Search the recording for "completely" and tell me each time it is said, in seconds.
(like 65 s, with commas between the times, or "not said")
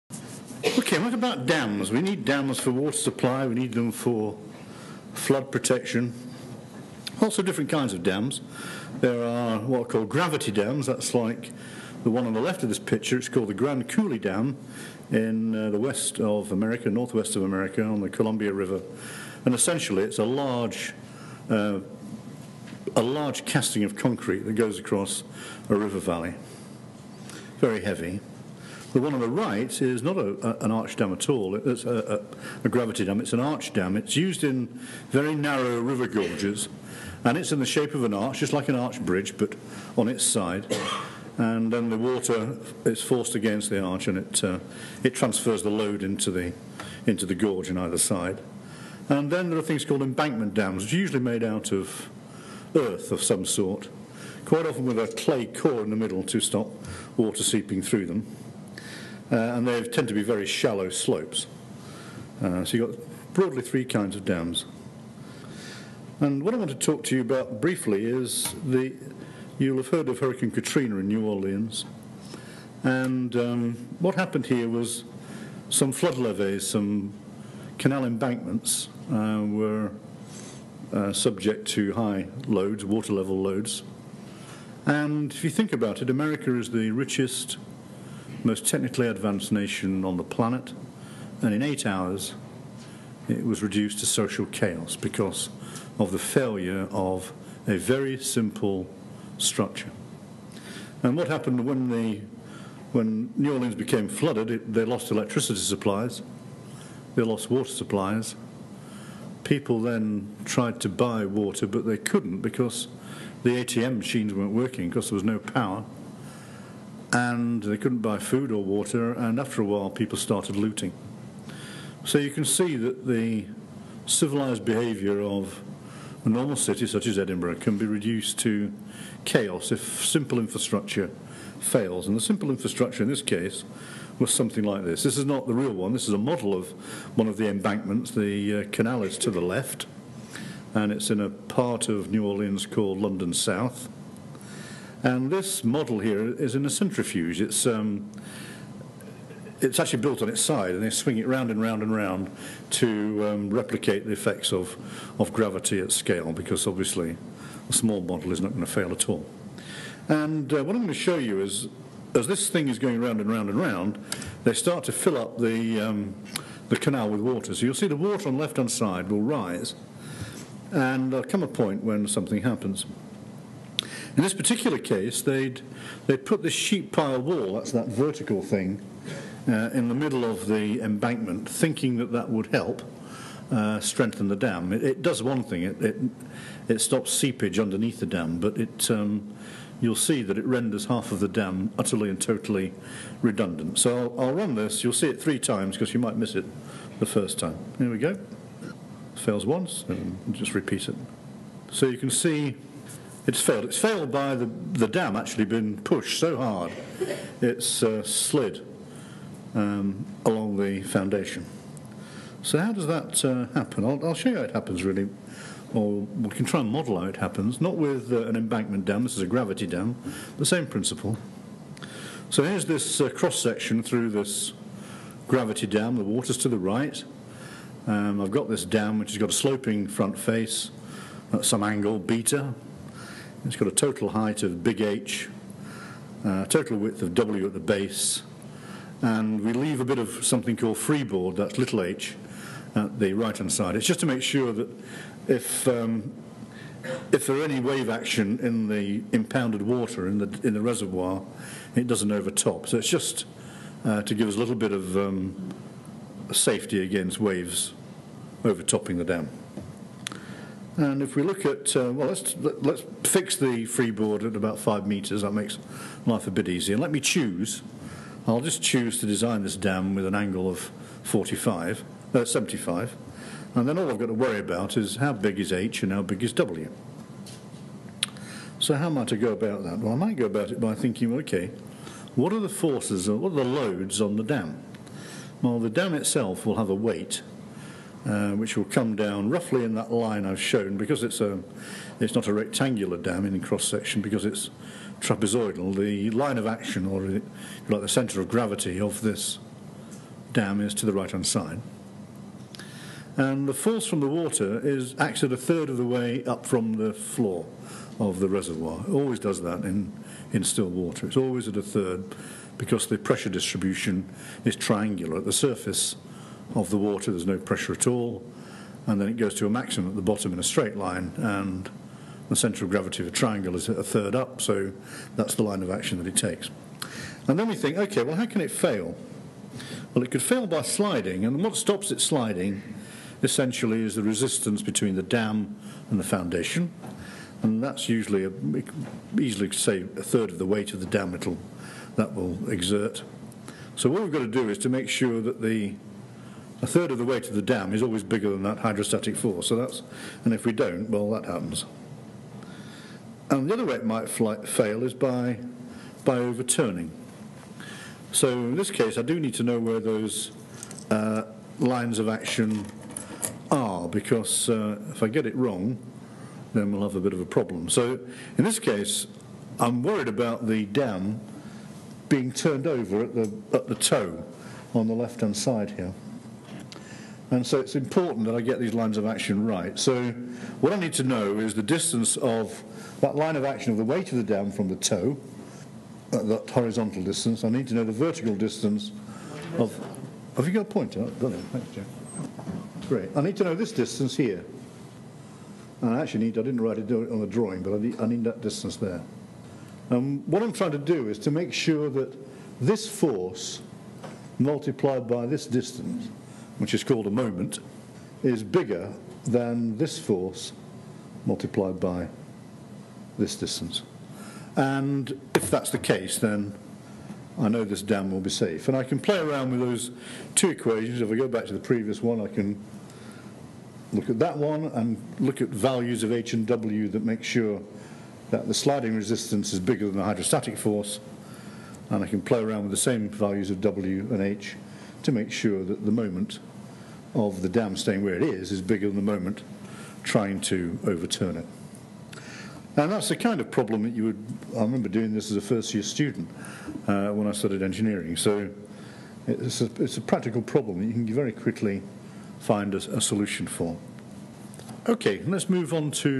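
not said.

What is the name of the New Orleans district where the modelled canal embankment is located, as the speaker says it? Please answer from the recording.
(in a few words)
London South.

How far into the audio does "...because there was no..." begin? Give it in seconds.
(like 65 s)
114 s.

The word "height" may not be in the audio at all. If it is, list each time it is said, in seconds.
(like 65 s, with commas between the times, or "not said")
234 s.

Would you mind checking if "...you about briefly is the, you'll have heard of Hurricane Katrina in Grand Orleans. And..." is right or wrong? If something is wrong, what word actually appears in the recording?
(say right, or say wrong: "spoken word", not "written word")
wrong: "New", not "Grand".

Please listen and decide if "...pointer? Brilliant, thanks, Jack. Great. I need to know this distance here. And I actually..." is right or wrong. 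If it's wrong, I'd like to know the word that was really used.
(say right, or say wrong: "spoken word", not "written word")
right.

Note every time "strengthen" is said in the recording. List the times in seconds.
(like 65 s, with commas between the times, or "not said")
183 s.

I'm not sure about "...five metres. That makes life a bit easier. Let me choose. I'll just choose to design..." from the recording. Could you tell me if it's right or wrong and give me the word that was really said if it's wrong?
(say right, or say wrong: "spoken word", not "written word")
right.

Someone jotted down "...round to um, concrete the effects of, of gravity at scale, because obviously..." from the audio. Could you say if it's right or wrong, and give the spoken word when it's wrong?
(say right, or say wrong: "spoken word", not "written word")
wrong: "replicate", not "concrete".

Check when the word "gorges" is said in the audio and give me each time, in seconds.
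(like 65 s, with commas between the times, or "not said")
36 s, 47 s.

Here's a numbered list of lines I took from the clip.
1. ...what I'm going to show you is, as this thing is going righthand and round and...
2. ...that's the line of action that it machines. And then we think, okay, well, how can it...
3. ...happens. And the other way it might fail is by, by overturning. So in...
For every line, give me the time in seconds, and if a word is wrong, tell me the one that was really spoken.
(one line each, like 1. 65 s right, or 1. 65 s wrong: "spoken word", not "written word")
1. 160 s wrong: "round", not "righthand"
2. 325 s wrong: "takes", not "machines"
3. 351 s right.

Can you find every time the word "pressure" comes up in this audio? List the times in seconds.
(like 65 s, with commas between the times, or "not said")
312 s, 317 s.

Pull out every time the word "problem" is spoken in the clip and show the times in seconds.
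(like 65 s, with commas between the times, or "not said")
367 s, 443 s, 450 s.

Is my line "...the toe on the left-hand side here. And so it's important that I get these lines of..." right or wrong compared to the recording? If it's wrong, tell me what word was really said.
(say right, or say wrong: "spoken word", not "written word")
right.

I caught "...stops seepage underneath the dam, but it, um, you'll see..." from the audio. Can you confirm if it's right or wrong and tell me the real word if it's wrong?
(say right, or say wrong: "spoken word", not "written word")
right.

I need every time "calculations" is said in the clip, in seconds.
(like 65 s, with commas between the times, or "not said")
not said.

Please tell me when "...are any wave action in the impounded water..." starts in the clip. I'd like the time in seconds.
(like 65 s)
247 s.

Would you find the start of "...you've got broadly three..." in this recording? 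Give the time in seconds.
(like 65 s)
62 s.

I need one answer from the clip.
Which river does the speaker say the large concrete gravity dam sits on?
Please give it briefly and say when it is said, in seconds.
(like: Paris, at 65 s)
Columbia River, at 18 s.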